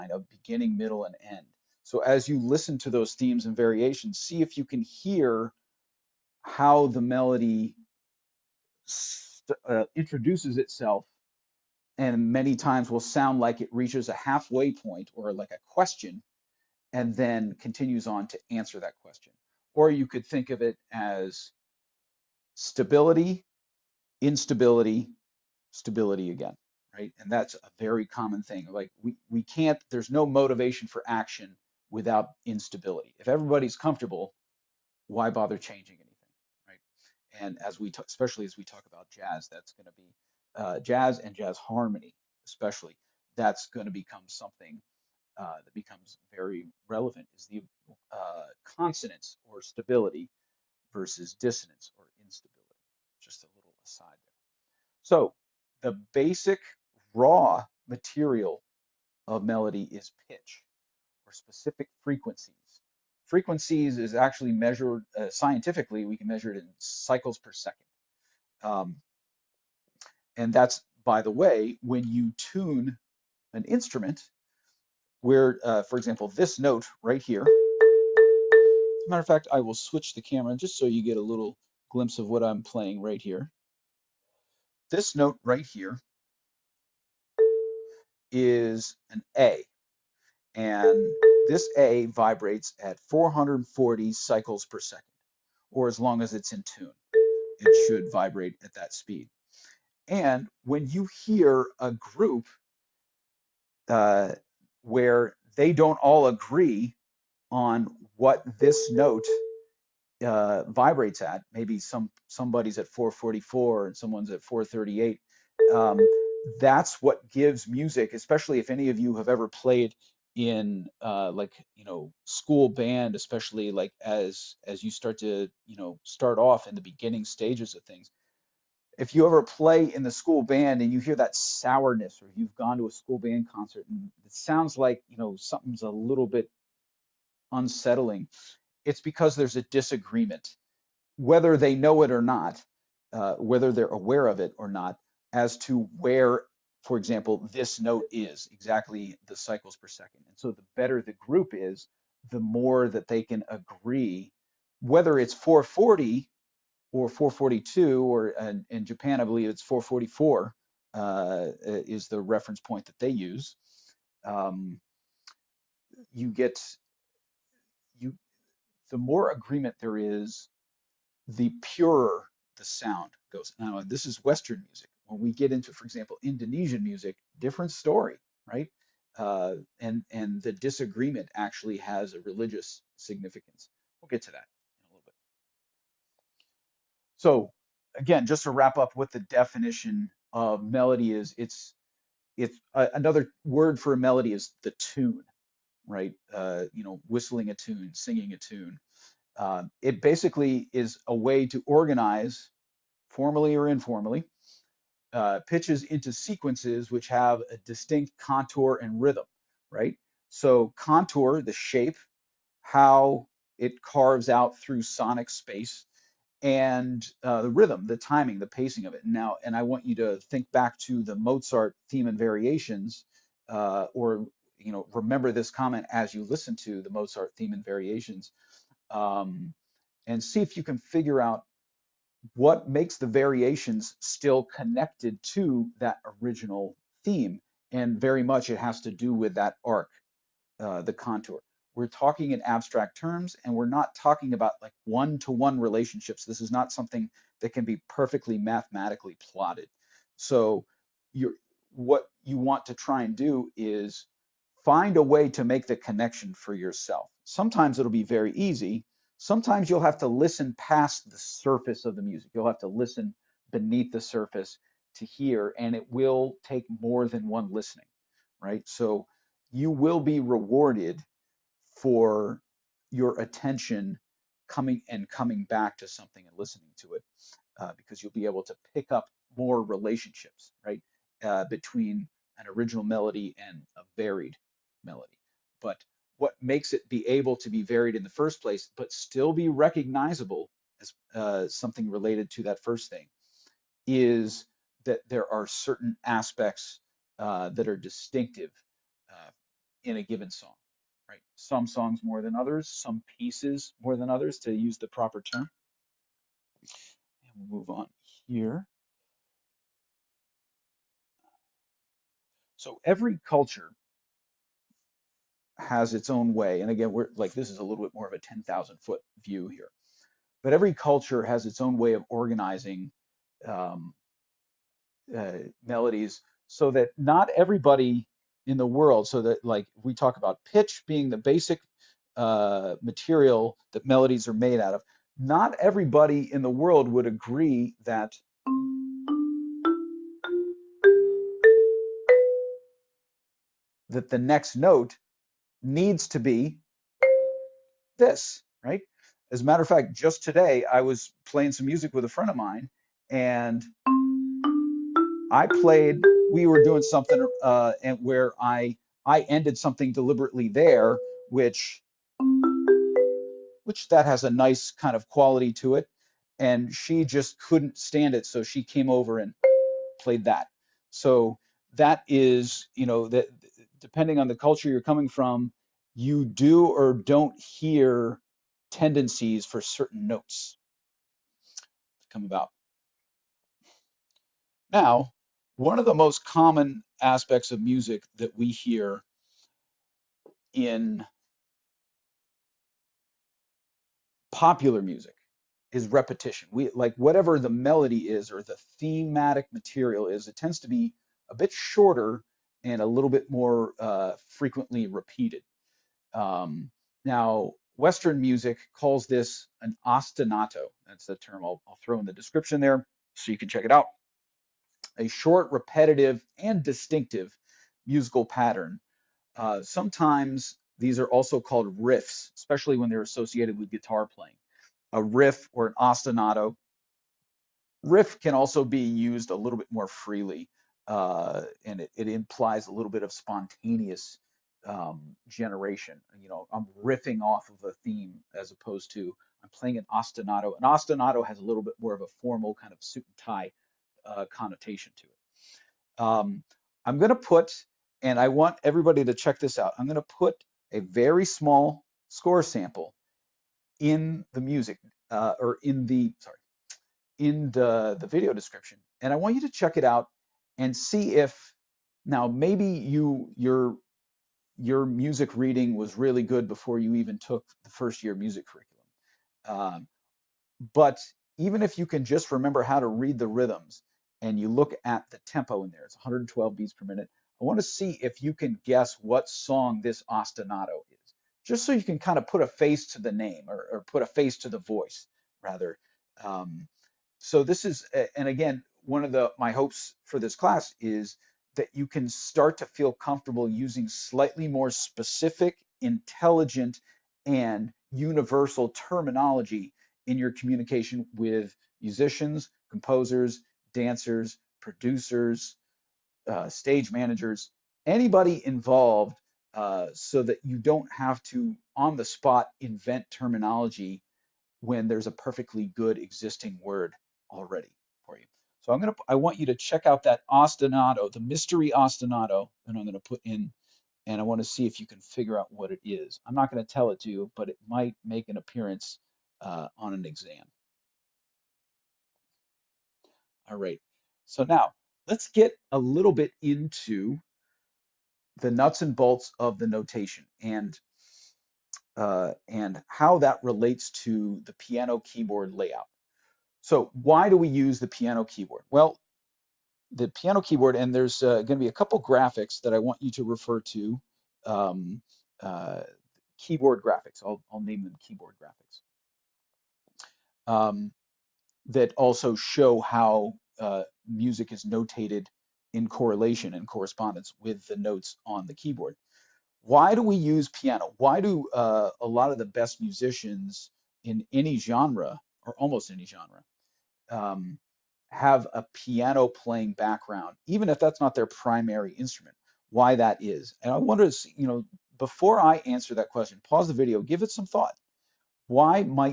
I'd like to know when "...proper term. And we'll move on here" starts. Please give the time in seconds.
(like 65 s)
304 s.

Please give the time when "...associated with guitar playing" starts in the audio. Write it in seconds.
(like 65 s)
423 s.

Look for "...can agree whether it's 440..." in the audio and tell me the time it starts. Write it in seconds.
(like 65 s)
153 s.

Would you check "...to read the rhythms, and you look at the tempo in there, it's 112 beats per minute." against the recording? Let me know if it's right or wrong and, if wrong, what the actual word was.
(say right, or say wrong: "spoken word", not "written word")
right.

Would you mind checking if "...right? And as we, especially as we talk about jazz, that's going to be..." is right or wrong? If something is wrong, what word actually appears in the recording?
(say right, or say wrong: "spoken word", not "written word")
right.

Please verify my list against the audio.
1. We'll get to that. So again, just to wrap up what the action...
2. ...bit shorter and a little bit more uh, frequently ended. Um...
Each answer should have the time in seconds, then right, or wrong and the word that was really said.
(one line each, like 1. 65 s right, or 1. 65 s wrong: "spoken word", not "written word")
1. 184 s wrong: "definition", not "action"
2. 401 s wrong: "repeated", not "ended".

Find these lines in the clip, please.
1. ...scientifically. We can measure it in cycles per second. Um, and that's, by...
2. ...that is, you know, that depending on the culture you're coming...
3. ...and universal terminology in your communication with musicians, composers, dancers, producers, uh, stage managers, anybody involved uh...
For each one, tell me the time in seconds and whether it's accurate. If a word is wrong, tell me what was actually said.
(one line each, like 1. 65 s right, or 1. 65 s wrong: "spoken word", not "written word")
1. 65 s right
2. 371 s right
3. 497 s right.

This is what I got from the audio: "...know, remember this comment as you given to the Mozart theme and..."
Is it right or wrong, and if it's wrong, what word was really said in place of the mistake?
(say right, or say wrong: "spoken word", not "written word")
wrong: "listen", not "given".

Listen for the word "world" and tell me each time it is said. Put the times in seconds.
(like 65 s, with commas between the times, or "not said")
328 s, 336 s.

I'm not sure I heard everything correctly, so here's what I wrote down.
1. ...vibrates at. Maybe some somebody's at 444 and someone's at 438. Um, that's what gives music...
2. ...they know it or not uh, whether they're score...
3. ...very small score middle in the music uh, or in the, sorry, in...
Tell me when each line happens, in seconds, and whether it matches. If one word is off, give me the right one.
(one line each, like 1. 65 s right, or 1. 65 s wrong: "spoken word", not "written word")
1. 110 s right
2. 141 s wrong: "aware", not "score"
3. 450 s wrong: "sample", not "middle".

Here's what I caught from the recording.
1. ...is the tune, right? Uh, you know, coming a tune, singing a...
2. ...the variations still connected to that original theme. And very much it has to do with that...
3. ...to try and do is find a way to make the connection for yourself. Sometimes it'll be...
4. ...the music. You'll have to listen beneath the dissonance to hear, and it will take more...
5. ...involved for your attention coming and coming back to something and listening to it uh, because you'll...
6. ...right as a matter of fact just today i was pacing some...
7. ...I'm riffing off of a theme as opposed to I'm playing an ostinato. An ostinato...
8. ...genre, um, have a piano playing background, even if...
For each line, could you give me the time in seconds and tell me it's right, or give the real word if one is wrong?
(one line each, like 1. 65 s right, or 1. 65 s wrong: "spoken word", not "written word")
1. 194 s wrong: "whistling", not "coming"
2. 232 s right
3. 252 s right
4. 261 s wrong: "surface", not "dissonance"
5. 270 s wrong: "rewarded", not "involved"
6. 348 s wrong: "playing", not "pacing"
7. 436 s right
8. 576 s right.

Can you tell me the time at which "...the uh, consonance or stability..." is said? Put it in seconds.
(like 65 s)
47 s.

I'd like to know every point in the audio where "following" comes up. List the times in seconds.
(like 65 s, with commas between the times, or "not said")
not said.